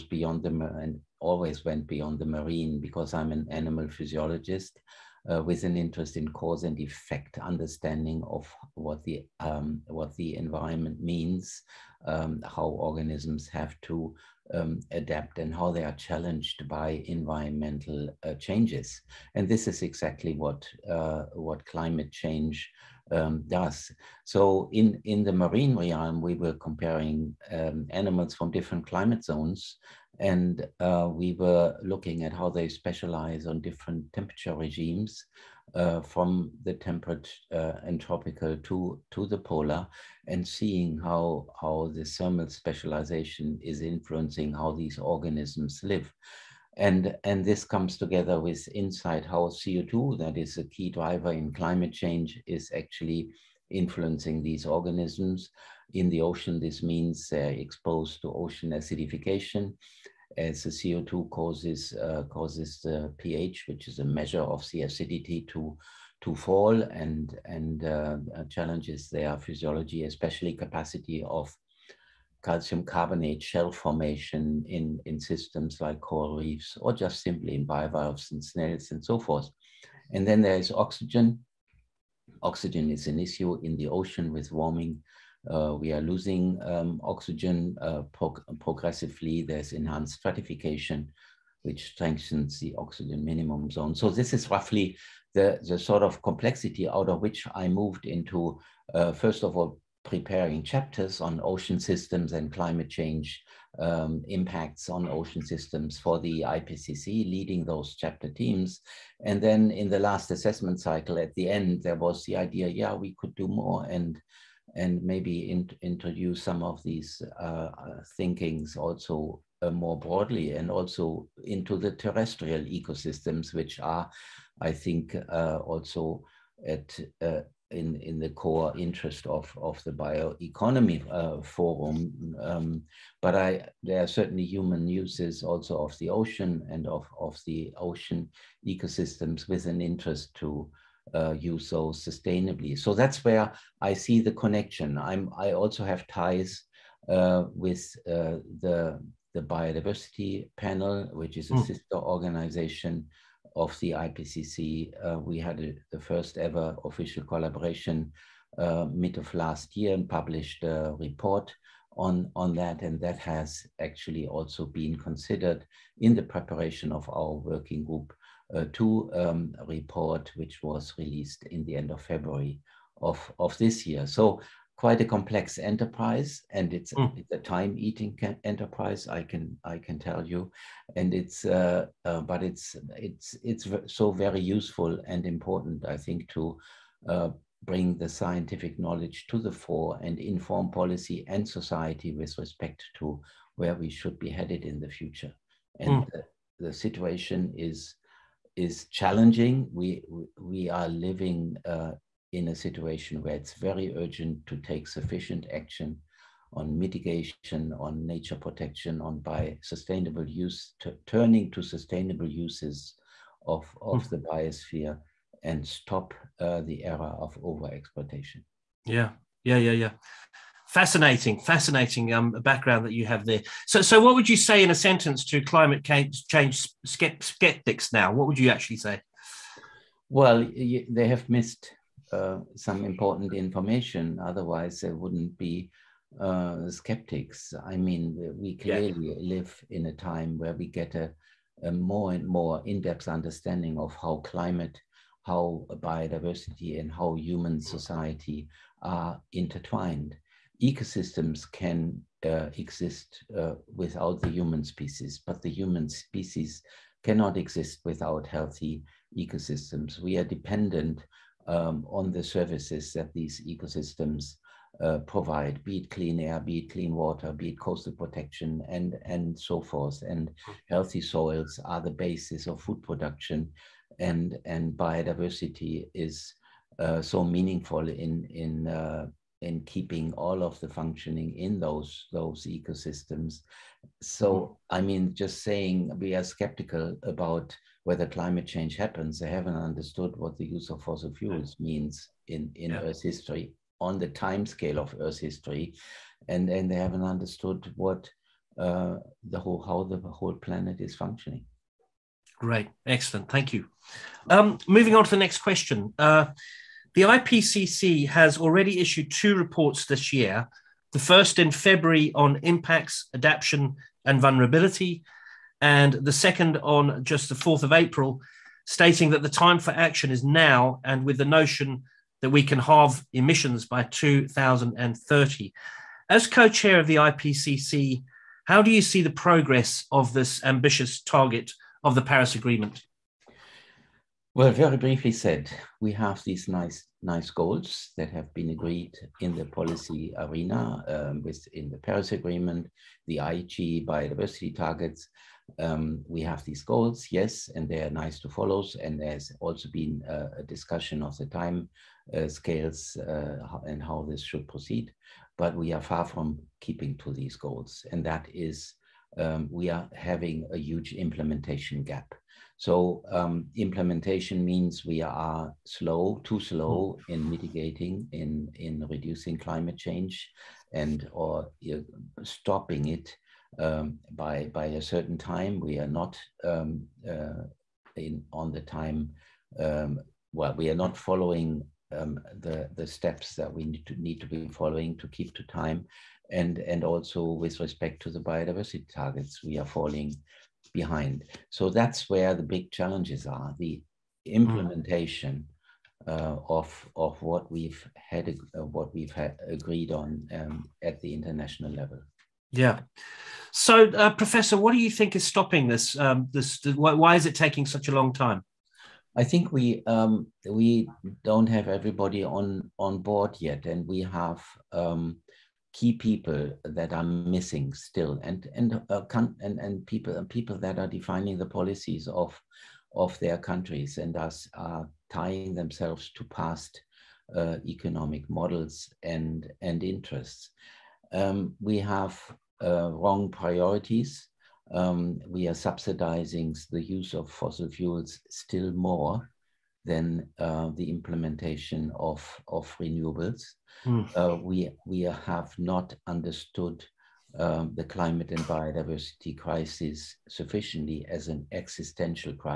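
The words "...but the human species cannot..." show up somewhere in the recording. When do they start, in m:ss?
4:15.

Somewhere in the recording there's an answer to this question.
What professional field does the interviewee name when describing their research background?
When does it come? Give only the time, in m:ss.
0:03.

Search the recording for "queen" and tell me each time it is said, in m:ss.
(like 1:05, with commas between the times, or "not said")
not said.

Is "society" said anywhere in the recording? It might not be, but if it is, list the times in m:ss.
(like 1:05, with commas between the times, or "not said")
3:11, 4:07.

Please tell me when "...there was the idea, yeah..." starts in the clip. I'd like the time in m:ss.
1:51.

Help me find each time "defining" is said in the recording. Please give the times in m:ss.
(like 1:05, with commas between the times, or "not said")
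7:00.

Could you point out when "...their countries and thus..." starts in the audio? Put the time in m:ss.
7:03.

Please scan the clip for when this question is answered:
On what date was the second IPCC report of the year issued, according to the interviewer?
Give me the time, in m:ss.
5:17.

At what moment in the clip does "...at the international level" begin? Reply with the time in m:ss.
6:40.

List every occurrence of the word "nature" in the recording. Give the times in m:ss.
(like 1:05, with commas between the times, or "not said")
3:28.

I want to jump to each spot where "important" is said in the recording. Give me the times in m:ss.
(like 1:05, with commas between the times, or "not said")
3:05, 3:52.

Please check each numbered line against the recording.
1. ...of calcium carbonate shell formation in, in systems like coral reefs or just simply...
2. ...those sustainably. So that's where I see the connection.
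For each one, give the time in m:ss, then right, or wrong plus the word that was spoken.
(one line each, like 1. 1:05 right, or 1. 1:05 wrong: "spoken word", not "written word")
1. 1:11 right
2. 2:21 right.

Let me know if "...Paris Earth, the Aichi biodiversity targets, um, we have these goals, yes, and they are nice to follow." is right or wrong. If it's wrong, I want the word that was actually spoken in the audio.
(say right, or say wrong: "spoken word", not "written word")
wrong: "Agreement", not "Earth".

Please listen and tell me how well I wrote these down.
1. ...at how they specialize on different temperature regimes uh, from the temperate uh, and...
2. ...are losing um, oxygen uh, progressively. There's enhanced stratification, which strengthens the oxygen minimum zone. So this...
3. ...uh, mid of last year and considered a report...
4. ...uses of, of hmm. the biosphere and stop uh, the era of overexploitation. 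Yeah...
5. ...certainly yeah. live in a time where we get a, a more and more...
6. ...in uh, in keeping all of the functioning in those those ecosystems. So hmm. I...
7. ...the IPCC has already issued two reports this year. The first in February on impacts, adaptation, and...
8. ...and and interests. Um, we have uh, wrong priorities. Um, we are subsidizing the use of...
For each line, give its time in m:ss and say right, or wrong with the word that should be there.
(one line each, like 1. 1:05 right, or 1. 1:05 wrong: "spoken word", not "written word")
1. 0:32 right
2. 1:25 right
3. 2:38 wrong: "published", not "considered"
4. 3:32 right
5. 3:58 wrong: "clearly", not "certainly"
6. 4:38 right
7. 5:06 right
8. 7:09 right.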